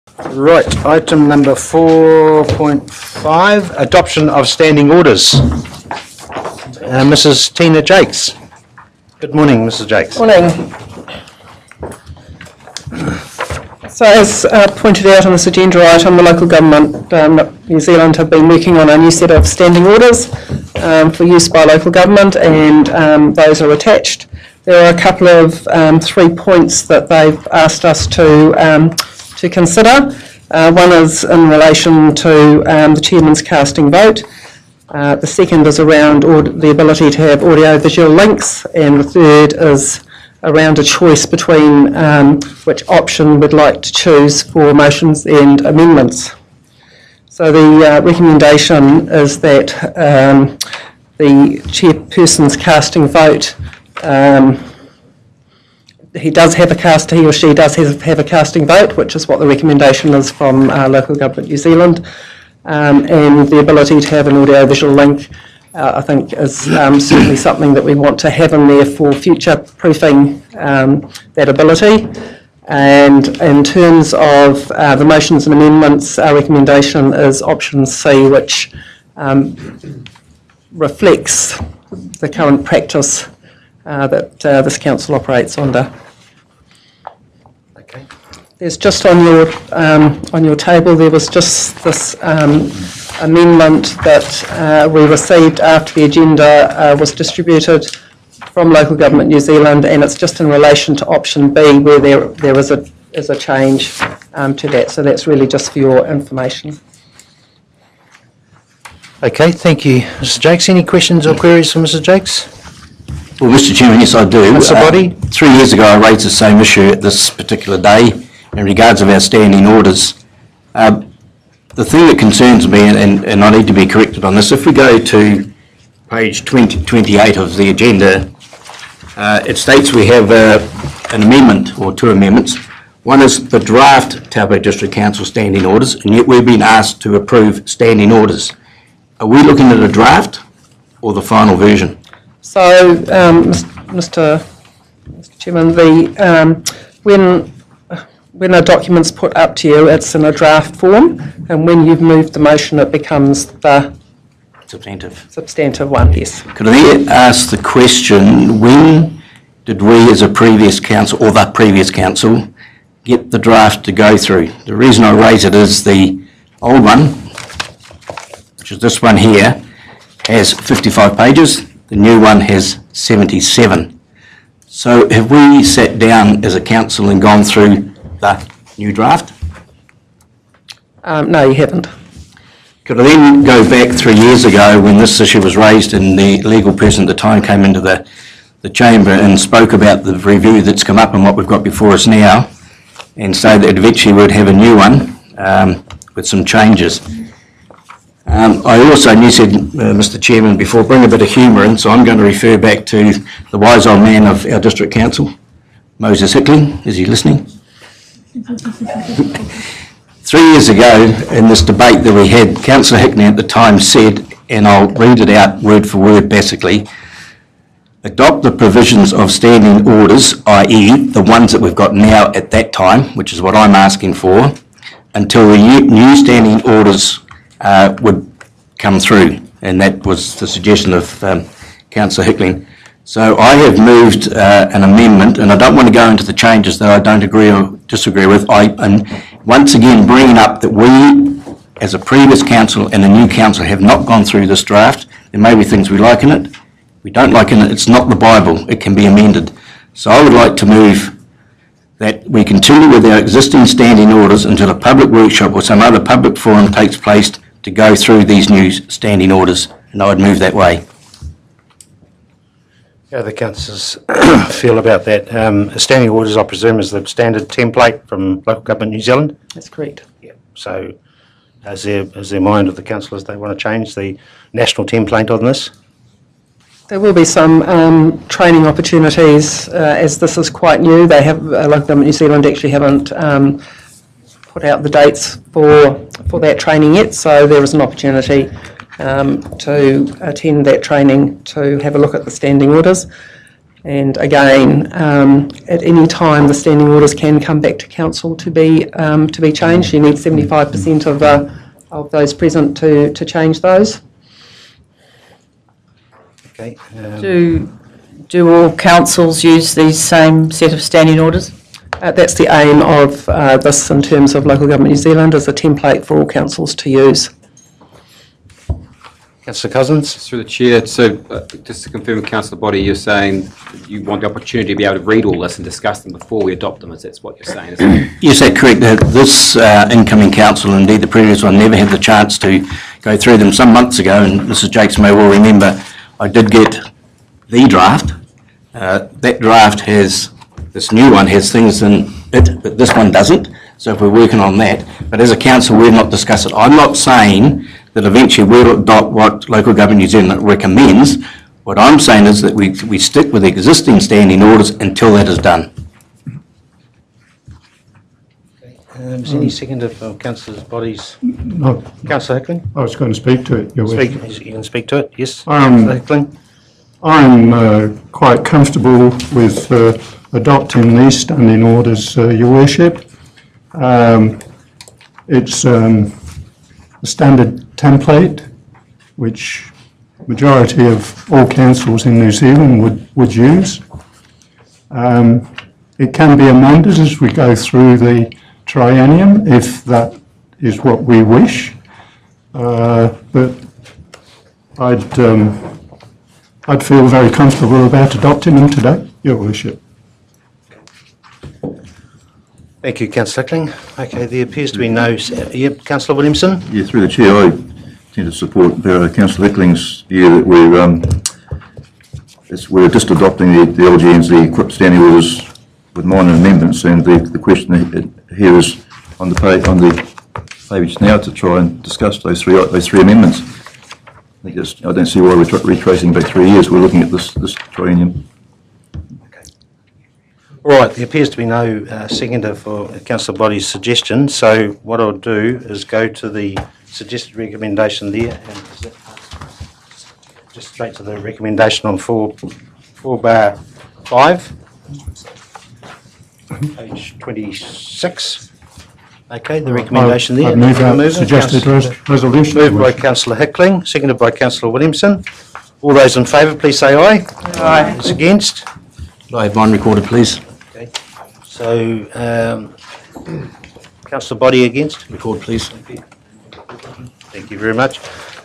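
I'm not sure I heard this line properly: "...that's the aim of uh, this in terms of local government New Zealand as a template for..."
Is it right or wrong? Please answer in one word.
right.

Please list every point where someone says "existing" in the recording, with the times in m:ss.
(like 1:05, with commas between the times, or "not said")
4:13, 5:53.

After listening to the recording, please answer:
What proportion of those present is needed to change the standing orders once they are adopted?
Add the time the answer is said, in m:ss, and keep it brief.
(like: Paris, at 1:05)
75%, at 5:00.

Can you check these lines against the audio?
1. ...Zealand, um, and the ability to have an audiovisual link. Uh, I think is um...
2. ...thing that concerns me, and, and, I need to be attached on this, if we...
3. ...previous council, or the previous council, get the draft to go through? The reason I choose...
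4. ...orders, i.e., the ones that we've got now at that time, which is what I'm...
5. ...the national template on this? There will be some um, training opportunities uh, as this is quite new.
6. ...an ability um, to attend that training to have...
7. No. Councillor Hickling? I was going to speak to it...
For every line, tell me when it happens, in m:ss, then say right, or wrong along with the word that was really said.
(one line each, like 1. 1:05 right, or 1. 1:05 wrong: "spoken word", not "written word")
1. 1:01 right
2. 2:01 wrong: "corrected", not "attached"
3. 2:40 wrong: "raise", not "choose"
4. 3:39 right
5. 4:33 right
6. 4:47 wrong: "opportunity", not "ability"
7. 6:01 right.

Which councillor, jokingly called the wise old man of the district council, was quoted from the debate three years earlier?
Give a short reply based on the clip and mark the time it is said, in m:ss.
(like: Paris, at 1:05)
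Moses Hickling, at 3:25.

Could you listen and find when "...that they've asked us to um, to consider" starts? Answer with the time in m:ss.
0:26.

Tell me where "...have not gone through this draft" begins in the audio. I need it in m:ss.
4:03.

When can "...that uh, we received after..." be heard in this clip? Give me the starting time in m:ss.
1:34.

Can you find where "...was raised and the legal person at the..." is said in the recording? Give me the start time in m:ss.
3:05.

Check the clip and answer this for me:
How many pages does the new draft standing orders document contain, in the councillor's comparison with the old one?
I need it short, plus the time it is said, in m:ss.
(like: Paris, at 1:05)
77, at 2:52.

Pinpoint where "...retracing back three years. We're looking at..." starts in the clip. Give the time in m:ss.
7:05.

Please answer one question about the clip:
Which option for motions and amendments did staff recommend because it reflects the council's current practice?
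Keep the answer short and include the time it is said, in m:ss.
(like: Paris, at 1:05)
Option C, at 1:17.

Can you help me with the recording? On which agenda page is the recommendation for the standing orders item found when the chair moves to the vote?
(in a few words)
26.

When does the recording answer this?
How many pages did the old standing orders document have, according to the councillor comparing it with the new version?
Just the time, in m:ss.
2:50.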